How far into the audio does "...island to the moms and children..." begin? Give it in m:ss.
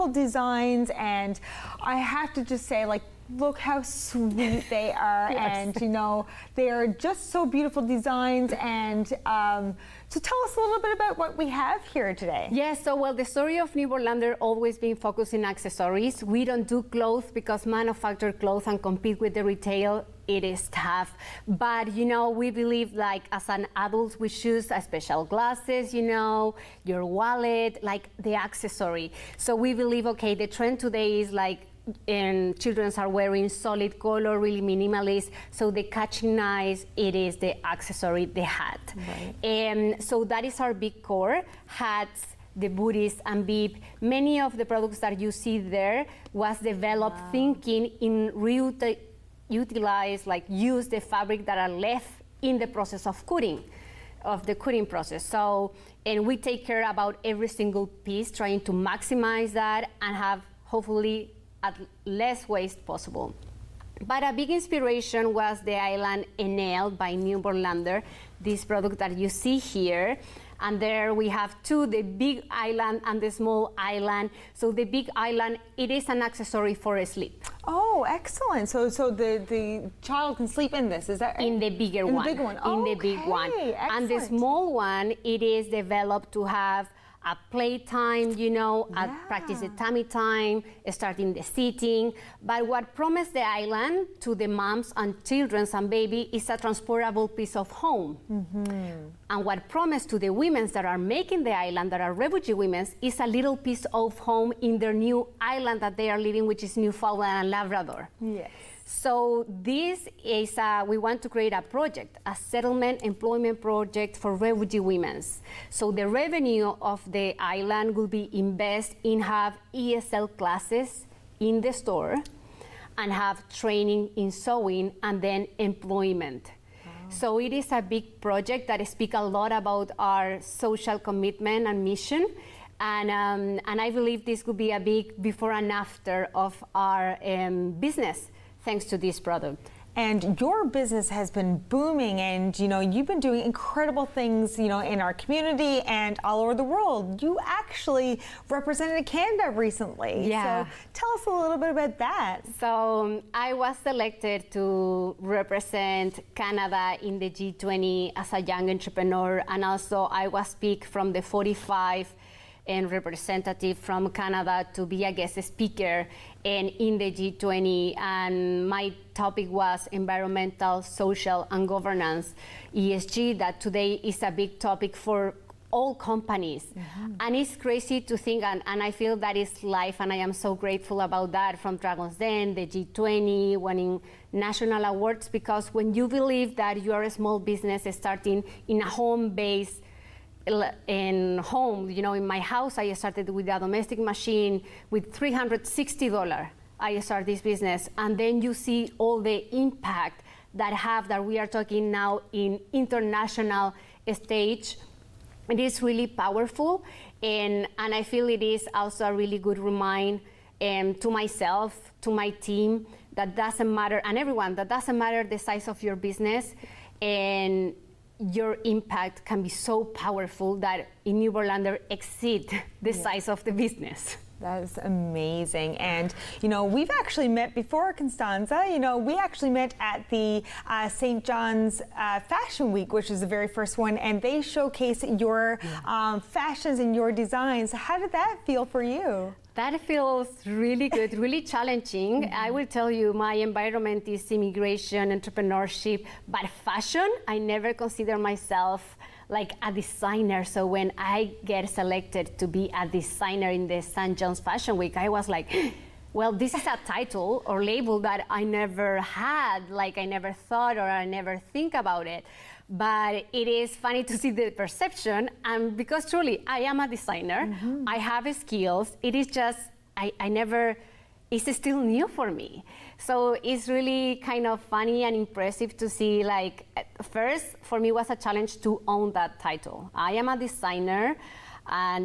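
1:33.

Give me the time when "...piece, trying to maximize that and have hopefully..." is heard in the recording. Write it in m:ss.
0:57.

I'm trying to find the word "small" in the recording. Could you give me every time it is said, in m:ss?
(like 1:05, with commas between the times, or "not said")
1:13, 1:24, 3:07.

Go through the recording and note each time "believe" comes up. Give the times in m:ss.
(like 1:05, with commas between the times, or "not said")
0:22, 0:29, 2:13, 3:06.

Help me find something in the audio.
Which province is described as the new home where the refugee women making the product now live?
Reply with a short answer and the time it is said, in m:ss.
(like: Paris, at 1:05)
Newfoundland and Labrador, at 1:46.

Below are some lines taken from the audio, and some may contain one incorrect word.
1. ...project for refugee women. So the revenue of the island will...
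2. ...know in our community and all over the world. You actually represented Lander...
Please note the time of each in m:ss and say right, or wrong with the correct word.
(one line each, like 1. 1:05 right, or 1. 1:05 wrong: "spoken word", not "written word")
1. 1:53 right
2. 2:24 wrong: "Canada", not "Lander".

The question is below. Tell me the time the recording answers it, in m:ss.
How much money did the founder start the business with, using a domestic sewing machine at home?
3:15.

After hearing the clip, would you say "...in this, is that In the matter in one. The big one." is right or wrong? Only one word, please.
wrong.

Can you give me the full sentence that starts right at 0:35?
So the catching eyes, it is the accessory, the hat.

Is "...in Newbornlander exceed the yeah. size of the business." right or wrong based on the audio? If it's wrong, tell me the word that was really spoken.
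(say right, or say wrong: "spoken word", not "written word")
right.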